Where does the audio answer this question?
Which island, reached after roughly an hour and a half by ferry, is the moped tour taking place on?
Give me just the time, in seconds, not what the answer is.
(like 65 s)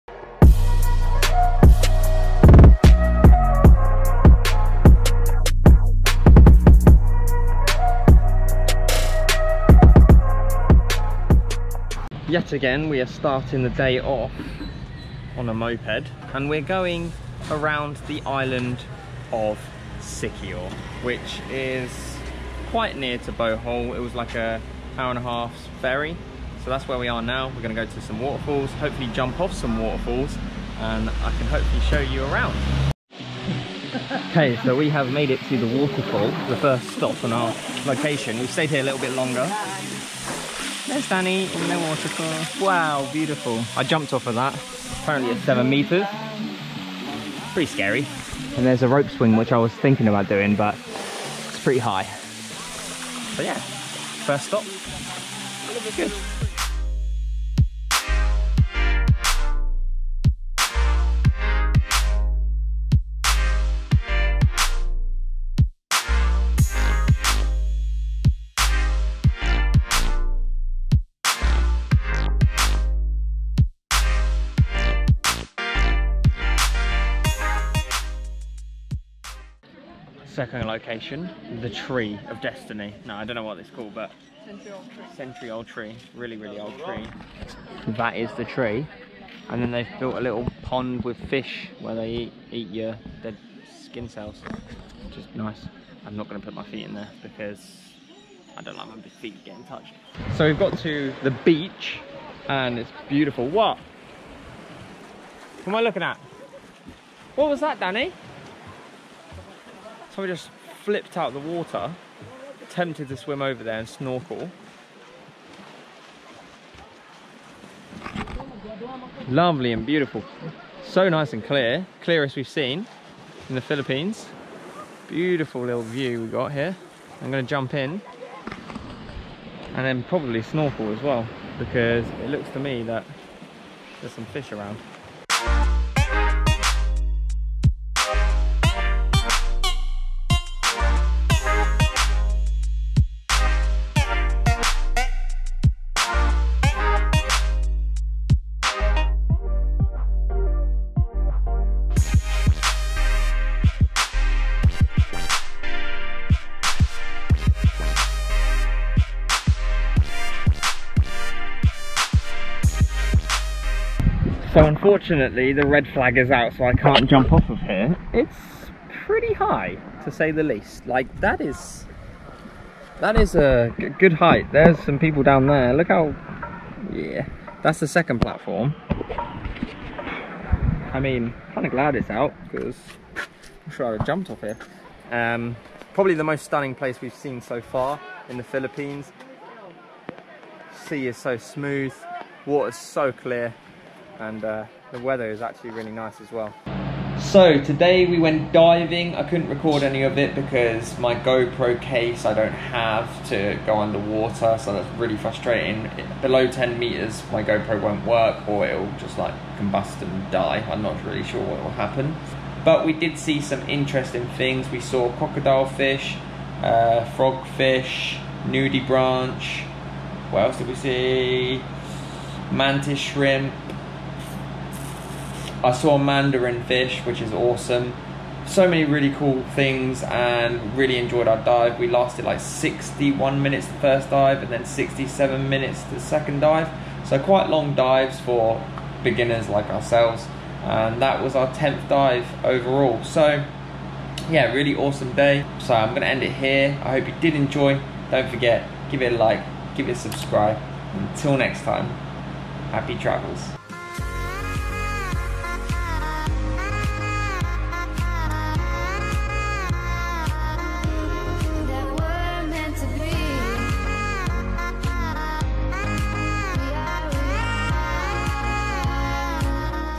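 19 s.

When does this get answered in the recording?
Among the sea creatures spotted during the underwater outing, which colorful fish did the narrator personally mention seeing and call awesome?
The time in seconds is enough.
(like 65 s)
225 s.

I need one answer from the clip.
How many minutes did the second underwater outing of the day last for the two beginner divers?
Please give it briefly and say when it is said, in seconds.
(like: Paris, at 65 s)
67 minutes, at 234 s.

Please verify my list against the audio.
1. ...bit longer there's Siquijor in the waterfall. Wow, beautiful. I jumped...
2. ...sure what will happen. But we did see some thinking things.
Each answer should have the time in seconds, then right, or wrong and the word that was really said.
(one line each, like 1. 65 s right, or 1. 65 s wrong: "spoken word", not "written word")
1. 39 s wrong: "Dani", not "Siquijor"
2. 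211 s wrong: "interesting", not "thinking".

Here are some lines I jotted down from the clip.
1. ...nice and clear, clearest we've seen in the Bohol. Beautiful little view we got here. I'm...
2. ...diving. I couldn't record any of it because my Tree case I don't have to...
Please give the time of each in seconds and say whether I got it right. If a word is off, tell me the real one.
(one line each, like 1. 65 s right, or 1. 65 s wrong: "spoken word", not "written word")
1. 121 s wrong: "Philippines", not "Bohol"
2. 198 s wrong: "GoPro", not "Tree".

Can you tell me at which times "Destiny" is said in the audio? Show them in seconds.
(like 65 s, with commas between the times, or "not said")
82 s.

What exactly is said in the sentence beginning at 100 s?
So we've got to the beach and it's beautiful.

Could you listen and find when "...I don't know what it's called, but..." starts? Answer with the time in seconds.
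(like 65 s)
83 s.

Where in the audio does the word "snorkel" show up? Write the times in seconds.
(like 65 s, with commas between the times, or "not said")
113 s, 130 s.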